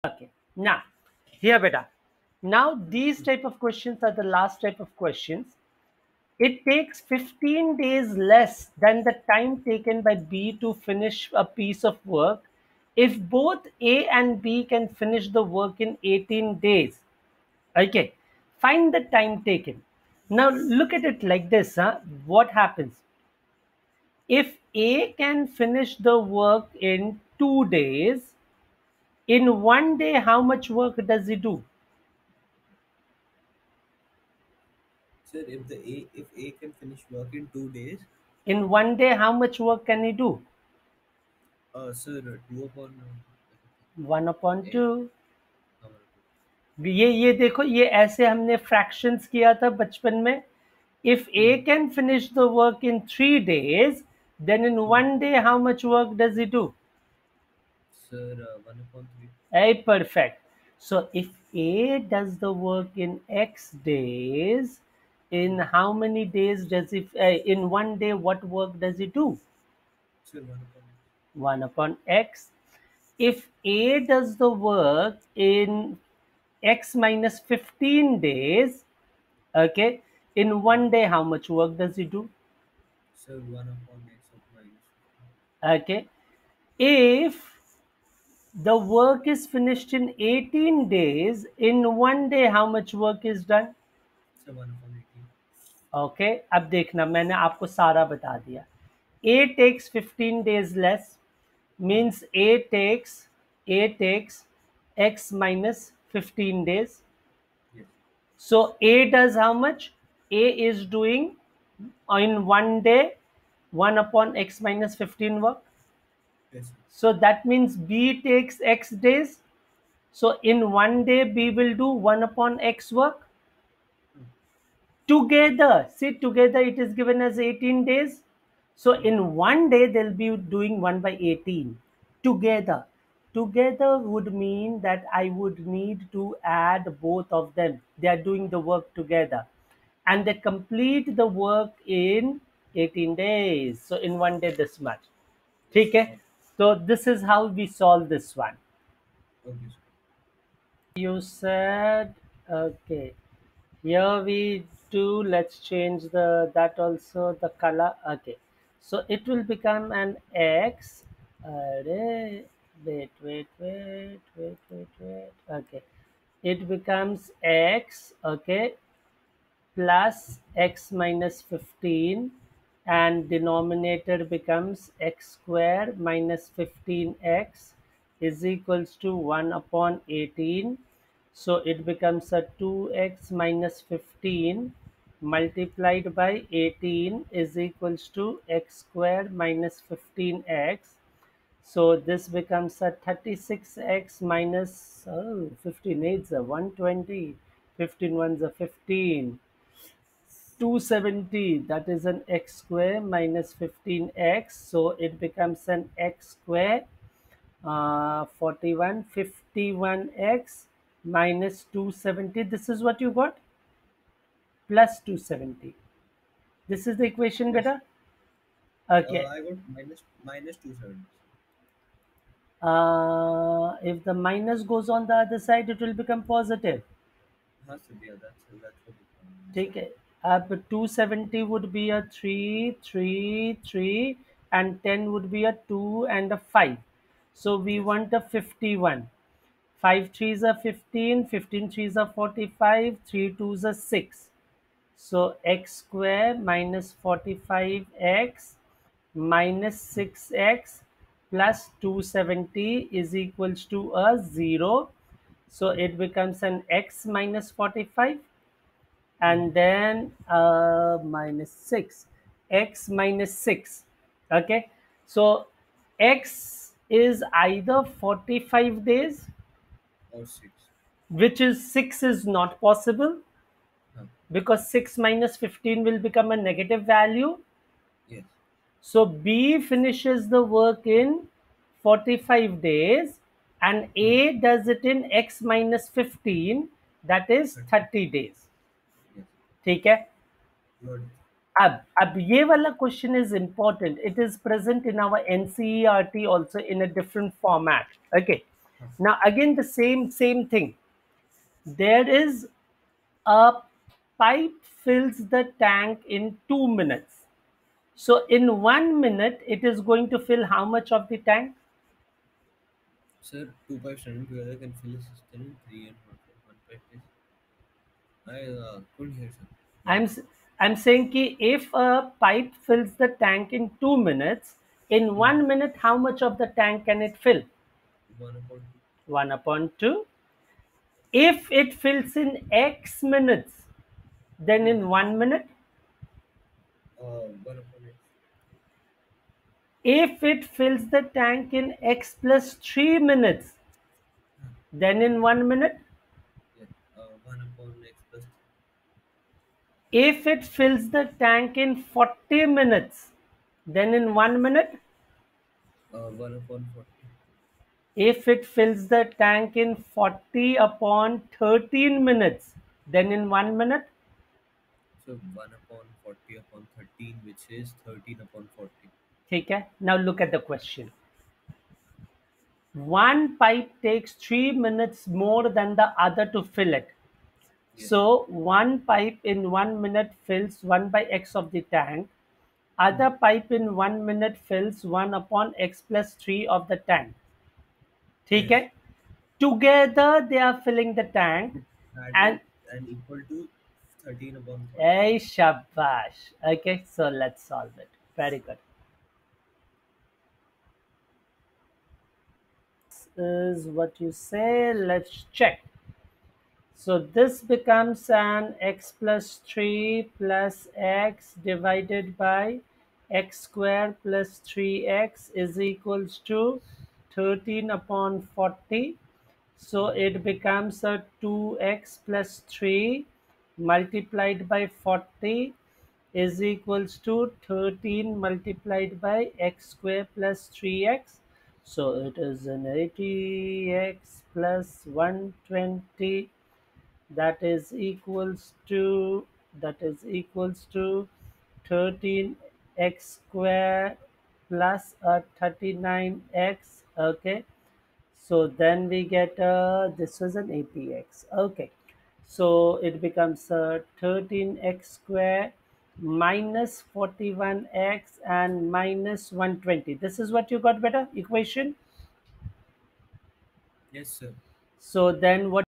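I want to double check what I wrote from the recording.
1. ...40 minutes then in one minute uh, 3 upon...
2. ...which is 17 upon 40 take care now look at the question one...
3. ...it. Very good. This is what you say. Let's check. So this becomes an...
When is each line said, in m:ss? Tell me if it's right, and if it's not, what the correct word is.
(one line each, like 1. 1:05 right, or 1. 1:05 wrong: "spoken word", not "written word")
1. 5:51 wrong: "1", not "3"
2. 6:07 wrong: "13", not "17"
3. 6:37 right.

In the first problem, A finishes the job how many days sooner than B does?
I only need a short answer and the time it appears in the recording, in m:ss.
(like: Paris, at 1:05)
15 days, at 0:07.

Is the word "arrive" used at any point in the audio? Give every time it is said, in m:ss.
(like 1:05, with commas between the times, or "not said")
not said.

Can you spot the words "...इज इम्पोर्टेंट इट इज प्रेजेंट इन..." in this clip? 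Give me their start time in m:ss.
4:53.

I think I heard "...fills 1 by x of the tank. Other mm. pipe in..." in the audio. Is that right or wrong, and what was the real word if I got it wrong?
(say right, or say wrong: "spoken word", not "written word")
right.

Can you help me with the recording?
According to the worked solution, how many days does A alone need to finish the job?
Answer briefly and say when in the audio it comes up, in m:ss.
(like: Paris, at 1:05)
30 days, at 4:47.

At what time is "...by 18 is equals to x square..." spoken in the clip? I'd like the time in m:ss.
3:06.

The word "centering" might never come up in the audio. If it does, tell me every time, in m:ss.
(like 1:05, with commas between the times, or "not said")
not said.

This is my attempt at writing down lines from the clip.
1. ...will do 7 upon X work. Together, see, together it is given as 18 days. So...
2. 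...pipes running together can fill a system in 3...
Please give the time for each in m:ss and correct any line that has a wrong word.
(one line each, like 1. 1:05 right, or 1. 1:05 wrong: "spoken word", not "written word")
1. 2:01 wrong: "1", not "7"
2. 5:13 right.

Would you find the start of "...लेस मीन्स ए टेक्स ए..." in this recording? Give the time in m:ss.
1:40.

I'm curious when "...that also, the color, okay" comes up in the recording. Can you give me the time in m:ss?
2:36.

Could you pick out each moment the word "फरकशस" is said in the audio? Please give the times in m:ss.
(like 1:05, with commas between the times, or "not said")
0:48.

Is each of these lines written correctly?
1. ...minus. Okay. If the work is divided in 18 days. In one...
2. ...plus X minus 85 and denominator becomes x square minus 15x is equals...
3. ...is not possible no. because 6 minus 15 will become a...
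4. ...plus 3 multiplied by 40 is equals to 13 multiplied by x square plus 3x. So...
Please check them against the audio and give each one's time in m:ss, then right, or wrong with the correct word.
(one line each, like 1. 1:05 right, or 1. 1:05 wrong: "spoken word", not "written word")
1. 1:24 wrong: "finished", not "divided"
2. 2:49 wrong: "15", not "85"
3. 4:32 right
4. 7:02 right.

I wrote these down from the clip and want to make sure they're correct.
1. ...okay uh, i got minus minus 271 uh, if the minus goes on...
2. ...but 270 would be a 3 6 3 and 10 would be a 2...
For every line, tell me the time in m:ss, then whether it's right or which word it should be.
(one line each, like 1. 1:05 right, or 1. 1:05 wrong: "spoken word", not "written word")
1. 3:39 wrong: "270", not "271"
2. 3:50 wrong: "3", not "6".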